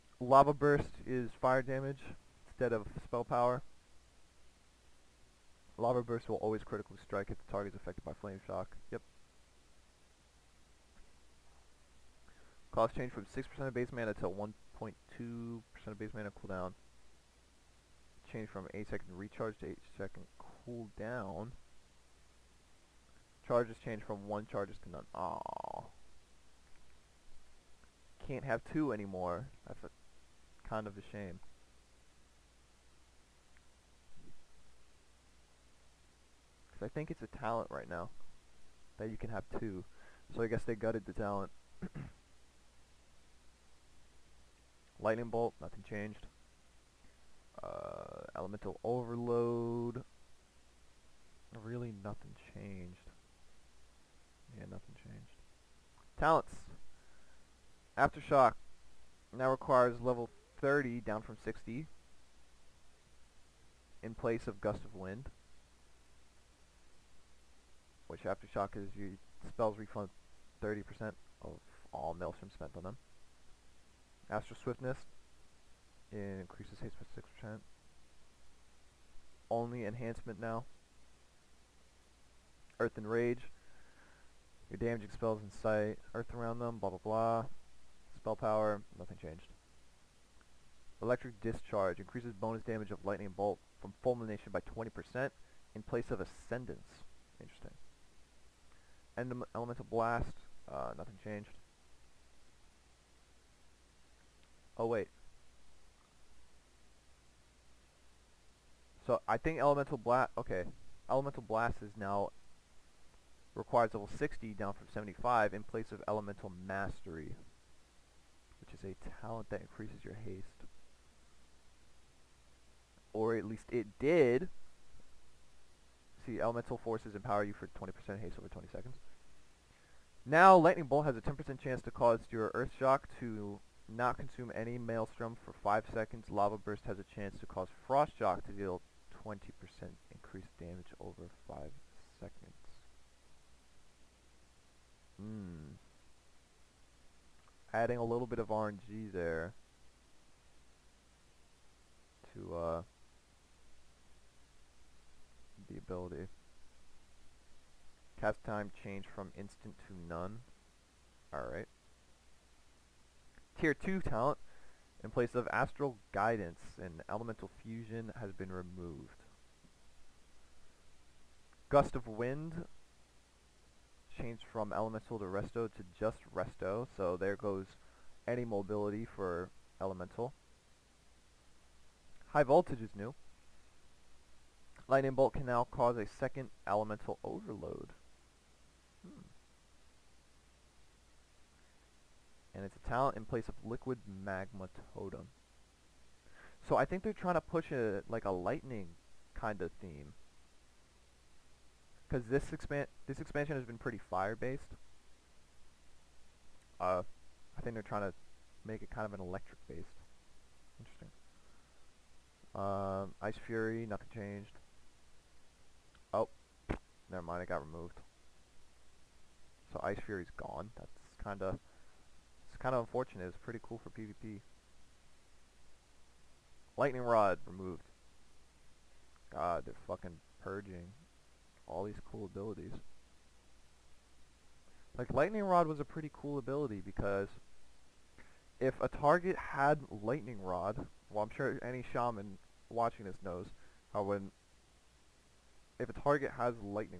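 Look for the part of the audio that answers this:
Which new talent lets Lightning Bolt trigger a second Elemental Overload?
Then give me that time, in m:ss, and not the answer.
3:02.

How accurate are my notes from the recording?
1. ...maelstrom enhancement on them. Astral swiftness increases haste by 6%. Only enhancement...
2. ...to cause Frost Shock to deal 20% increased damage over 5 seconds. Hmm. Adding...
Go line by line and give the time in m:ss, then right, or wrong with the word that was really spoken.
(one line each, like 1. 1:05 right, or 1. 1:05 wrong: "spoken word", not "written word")
1. 1:12 wrong: "spent", not "enhancement"
2. 2:17 right.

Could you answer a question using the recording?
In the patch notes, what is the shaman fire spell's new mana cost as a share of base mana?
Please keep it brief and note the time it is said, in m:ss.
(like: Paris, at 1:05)
1.2%, at 0:14.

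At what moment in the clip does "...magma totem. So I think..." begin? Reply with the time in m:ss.
3:14.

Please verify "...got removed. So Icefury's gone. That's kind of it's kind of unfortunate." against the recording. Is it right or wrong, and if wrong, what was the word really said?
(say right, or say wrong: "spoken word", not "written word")
right.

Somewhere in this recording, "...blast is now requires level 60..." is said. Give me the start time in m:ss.
1:51.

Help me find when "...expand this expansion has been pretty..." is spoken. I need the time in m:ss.
3:22.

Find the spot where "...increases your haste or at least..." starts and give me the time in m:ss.
1:59.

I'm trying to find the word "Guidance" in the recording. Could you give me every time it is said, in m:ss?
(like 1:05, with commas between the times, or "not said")
2:46.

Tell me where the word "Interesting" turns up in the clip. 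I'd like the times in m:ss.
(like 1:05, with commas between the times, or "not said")
1:37, 3:30.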